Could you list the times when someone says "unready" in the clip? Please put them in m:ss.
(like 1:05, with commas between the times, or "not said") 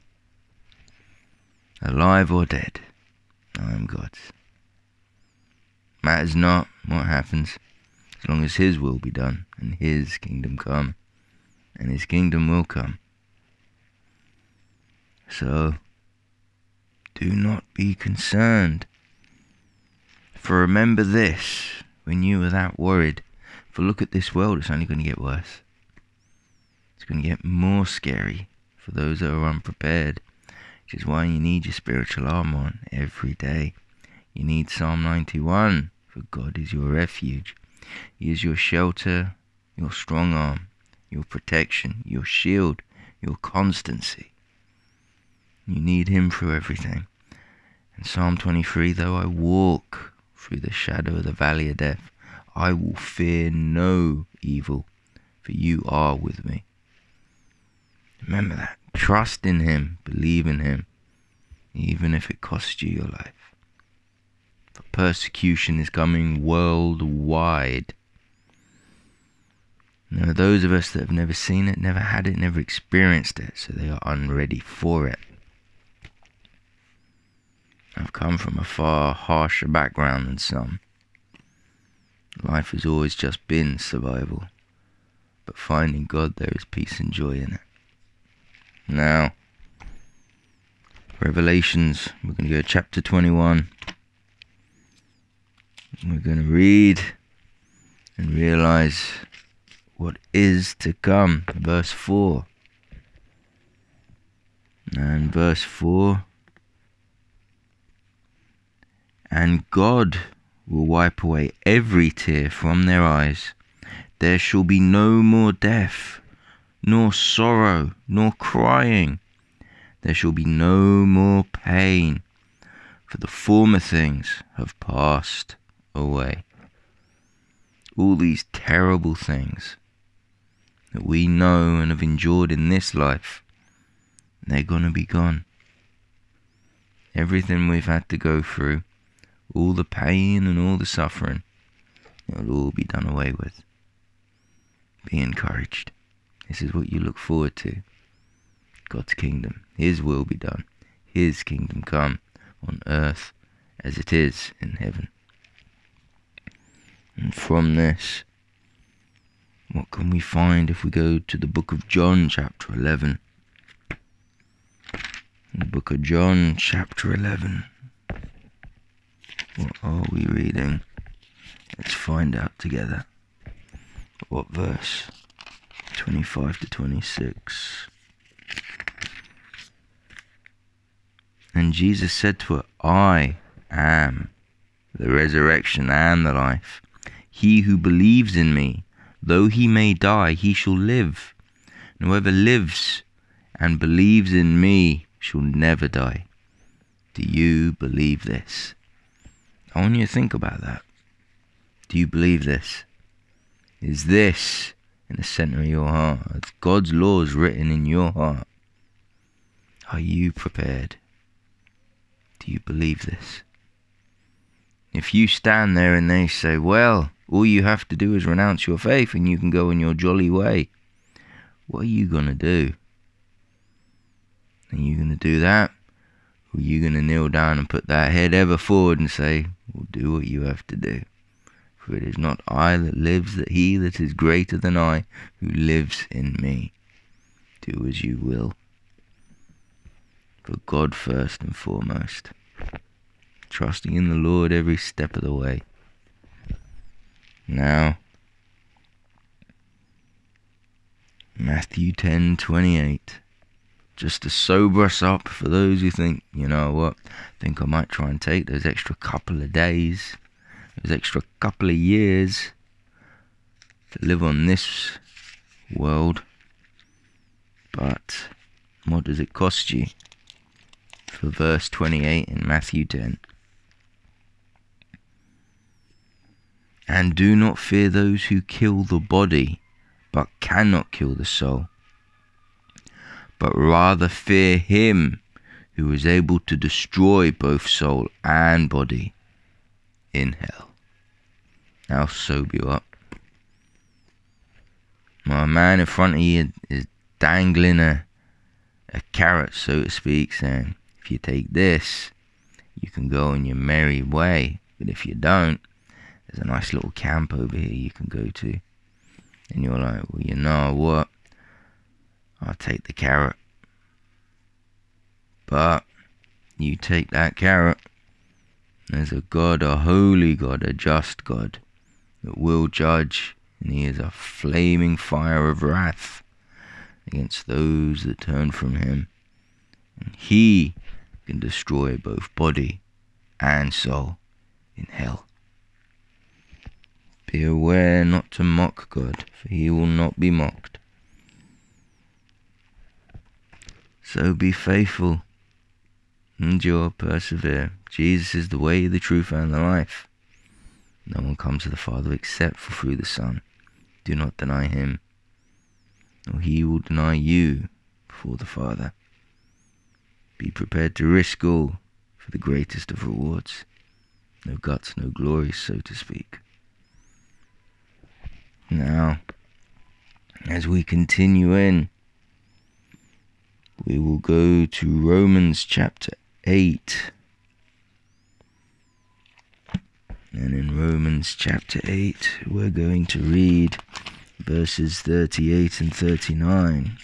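1:14.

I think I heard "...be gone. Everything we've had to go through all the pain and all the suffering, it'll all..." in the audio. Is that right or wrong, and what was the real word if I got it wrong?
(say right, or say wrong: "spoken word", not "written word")
right.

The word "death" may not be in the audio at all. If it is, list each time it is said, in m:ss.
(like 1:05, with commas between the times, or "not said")
0:51, 1:55.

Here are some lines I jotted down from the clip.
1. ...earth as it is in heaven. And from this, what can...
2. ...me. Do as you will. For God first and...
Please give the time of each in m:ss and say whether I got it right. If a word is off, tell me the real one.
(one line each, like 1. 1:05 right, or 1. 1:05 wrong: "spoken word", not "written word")
1. 2:32 right
2. 3:56 right.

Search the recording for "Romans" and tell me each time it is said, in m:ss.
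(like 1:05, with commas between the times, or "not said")
6:14, 6:20.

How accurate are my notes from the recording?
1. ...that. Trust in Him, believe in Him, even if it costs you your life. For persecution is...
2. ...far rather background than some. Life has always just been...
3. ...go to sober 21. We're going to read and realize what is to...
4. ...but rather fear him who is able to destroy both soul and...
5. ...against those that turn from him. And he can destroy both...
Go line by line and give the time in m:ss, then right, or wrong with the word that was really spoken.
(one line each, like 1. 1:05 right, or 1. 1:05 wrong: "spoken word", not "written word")
1. 0:58 right
2. 1:18 wrong: "harsher", not "rather"
3. 1:32 wrong: "chapter", not "sober"
4. 4:43 right
5. 5:27 right.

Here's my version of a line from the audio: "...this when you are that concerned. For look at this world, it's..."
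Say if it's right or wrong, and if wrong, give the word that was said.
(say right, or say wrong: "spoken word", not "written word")
wrong: "worried", not "concerned".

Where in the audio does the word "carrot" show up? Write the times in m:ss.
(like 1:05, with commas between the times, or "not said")
4:59, 5:12, 5:17.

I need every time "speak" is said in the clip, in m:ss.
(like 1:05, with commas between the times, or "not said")
4:59, 6:05.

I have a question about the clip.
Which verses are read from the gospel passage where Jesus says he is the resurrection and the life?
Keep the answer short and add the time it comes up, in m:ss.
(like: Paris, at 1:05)
25 to 26, at 2:55.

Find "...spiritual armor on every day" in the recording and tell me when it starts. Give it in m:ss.
0:31.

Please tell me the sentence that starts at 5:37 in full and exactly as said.
Beware not to mock God, for he will not be mocked.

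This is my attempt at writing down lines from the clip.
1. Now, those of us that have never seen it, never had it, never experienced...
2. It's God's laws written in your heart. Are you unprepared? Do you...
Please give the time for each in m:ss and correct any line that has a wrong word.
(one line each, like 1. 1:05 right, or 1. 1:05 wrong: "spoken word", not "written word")
1. 1:10 right
2. 3:26 wrong: "prepared", not "unprepared".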